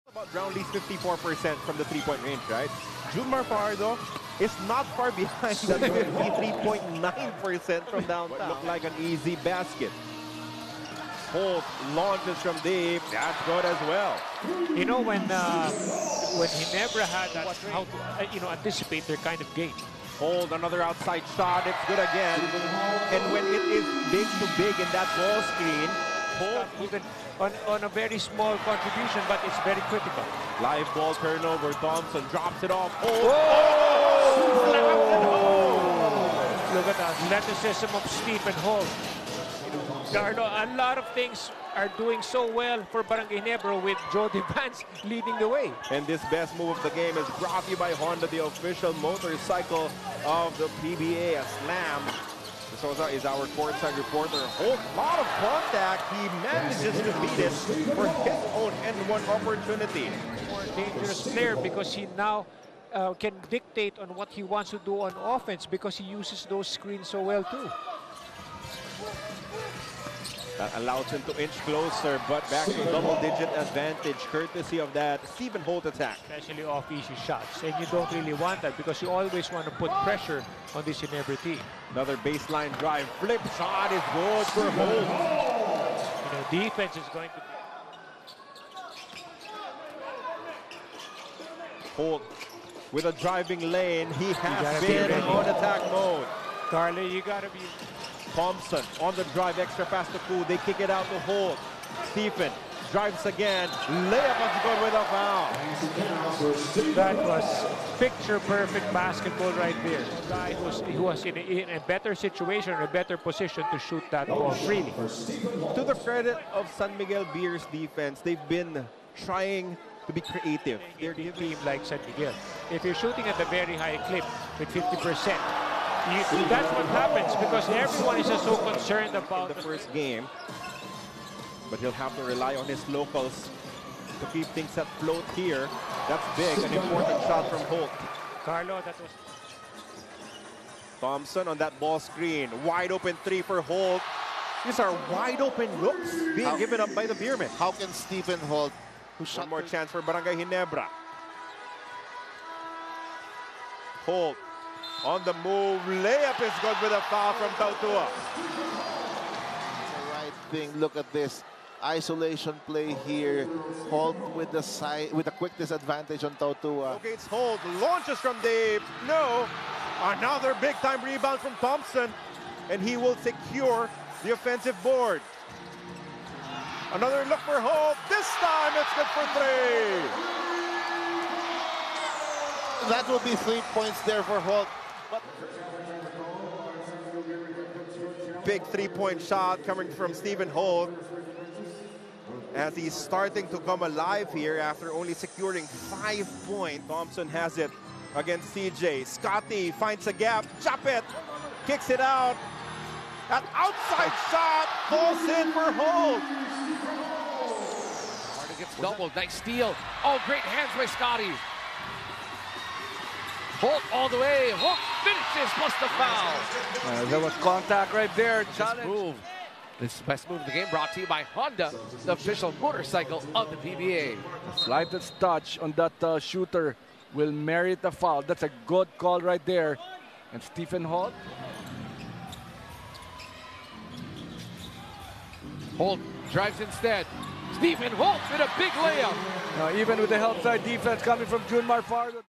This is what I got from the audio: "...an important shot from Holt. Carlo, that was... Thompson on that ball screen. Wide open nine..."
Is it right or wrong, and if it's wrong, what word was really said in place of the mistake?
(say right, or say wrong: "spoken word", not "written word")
wrong: "three", not "nine".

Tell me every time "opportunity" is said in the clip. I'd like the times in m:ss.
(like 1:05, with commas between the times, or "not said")
0:59.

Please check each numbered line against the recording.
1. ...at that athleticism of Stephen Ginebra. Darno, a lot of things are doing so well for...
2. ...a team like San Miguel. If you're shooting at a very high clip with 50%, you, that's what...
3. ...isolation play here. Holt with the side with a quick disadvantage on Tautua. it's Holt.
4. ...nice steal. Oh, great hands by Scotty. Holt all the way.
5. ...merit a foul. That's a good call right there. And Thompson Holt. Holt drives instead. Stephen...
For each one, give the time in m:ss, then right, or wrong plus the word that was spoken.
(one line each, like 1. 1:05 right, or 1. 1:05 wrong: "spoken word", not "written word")
1. 0:36 wrong: "Holt", not "Ginebra"
2. 2:01 right
3. 2:41 right
4. 3:29 right
5. 3:47 wrong: "Stephen", not "Thompson".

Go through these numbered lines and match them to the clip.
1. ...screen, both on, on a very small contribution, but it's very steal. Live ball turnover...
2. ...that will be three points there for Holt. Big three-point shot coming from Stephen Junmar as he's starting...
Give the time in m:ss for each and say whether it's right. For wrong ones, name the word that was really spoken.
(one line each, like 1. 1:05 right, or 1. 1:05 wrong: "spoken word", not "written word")
1. 0:25 wrong: "critical", not "steal"
2. 3:02 wrong: "Holt", not "Junmar".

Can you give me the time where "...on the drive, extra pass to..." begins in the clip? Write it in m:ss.
1:39.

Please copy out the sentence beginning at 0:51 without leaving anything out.
A slam so is our courtside reporter.